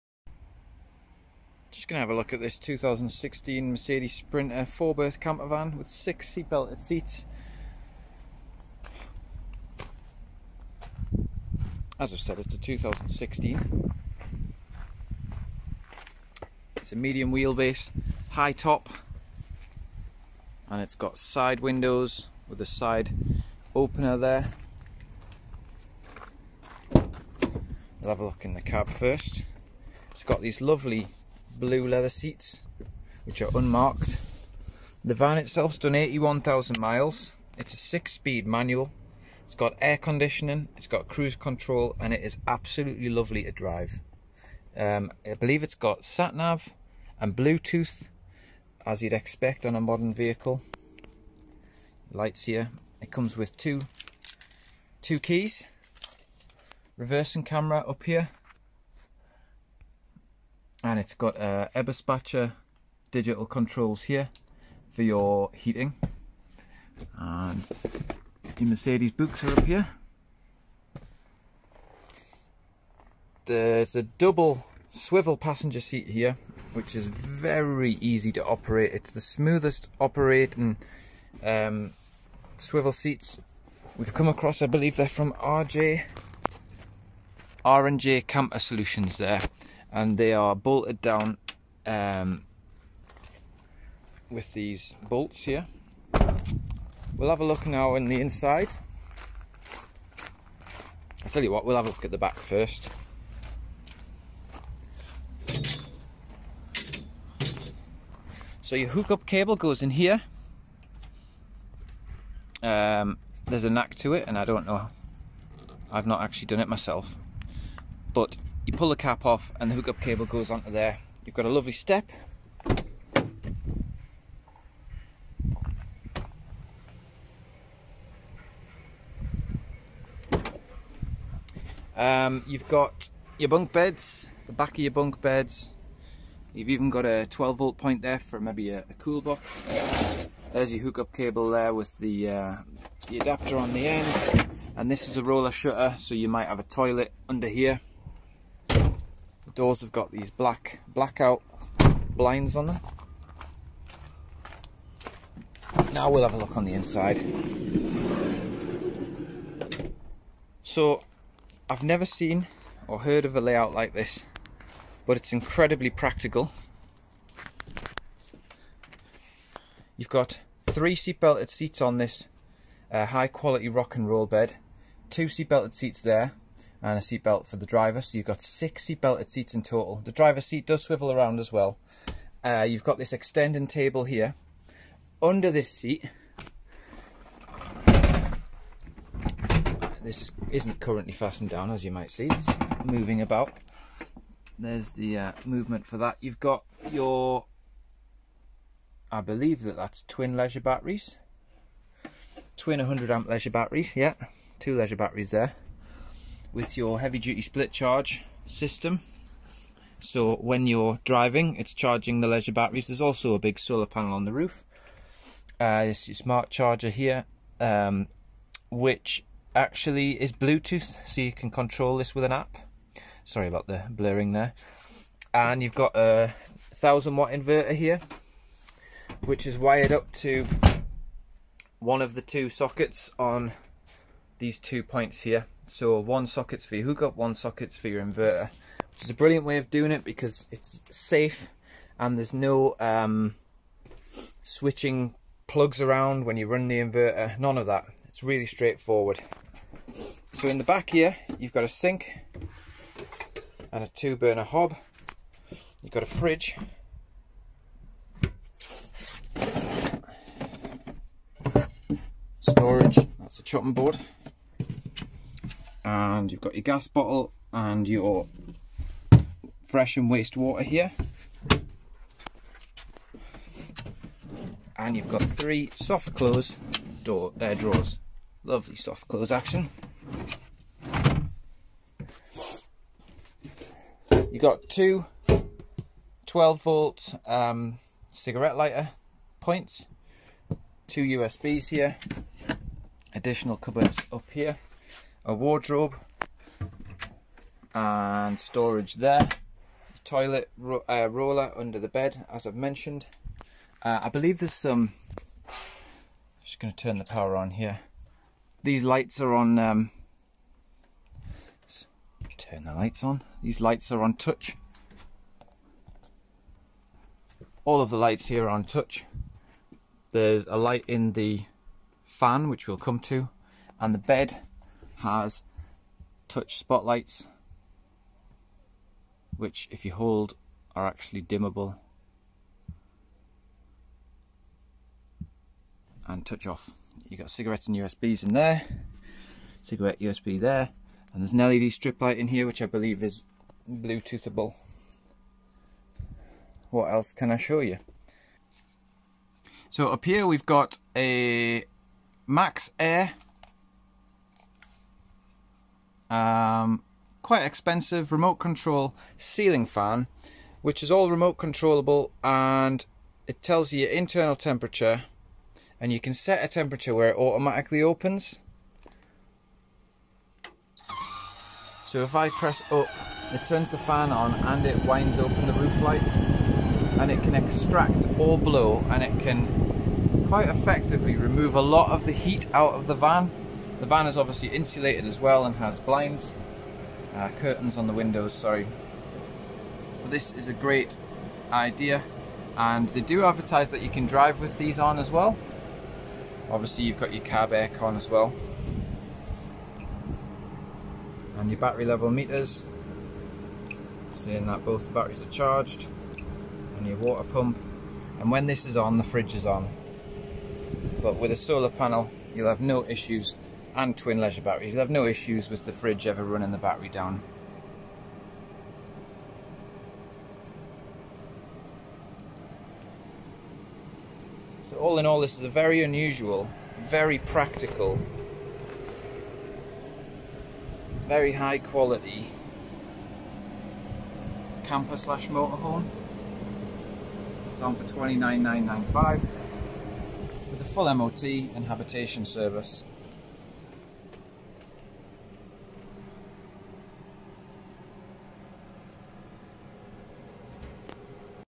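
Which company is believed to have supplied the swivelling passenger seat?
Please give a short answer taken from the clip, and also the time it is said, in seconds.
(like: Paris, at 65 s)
R&J Camper Solutions, at 87 s.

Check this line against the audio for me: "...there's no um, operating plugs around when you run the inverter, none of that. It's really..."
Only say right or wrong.
wrong.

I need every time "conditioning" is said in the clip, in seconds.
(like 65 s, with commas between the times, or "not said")
39 s.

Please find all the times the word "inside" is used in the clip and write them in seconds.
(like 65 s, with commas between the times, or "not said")
98 s, 156 s.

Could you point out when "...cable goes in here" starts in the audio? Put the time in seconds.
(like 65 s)
109 s.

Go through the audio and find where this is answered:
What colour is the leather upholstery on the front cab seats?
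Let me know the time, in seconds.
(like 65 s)
31 s.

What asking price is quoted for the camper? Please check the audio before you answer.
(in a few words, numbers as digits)
£29,995.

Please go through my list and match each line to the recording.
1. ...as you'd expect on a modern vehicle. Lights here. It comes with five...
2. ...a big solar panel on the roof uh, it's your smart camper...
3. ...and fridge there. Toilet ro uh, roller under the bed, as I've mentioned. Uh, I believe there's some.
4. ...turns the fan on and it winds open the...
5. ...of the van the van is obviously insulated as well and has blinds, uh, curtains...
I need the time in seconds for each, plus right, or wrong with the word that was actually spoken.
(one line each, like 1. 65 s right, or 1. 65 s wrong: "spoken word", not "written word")
1. 48 s wrong: "two", not "five"
2. 213 s wrong: "charger", not "camper"
3. 297 s wrong: "storage", not "fridge"
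4. 373 s right
5. 382 s right.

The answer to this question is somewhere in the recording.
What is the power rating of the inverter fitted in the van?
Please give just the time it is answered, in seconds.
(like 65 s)
226 s.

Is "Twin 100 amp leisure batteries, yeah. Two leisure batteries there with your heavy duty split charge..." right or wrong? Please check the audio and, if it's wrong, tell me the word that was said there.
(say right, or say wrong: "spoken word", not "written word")
right.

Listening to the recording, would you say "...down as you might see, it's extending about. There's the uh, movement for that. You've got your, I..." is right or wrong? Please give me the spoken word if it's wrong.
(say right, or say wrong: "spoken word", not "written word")
wrong: "moving", not "extending".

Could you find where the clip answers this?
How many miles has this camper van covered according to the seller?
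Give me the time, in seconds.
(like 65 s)
35 s.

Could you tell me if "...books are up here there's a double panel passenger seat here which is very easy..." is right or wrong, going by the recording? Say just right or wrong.
wrong.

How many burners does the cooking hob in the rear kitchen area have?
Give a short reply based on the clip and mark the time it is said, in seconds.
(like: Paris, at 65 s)
2, at 253 s.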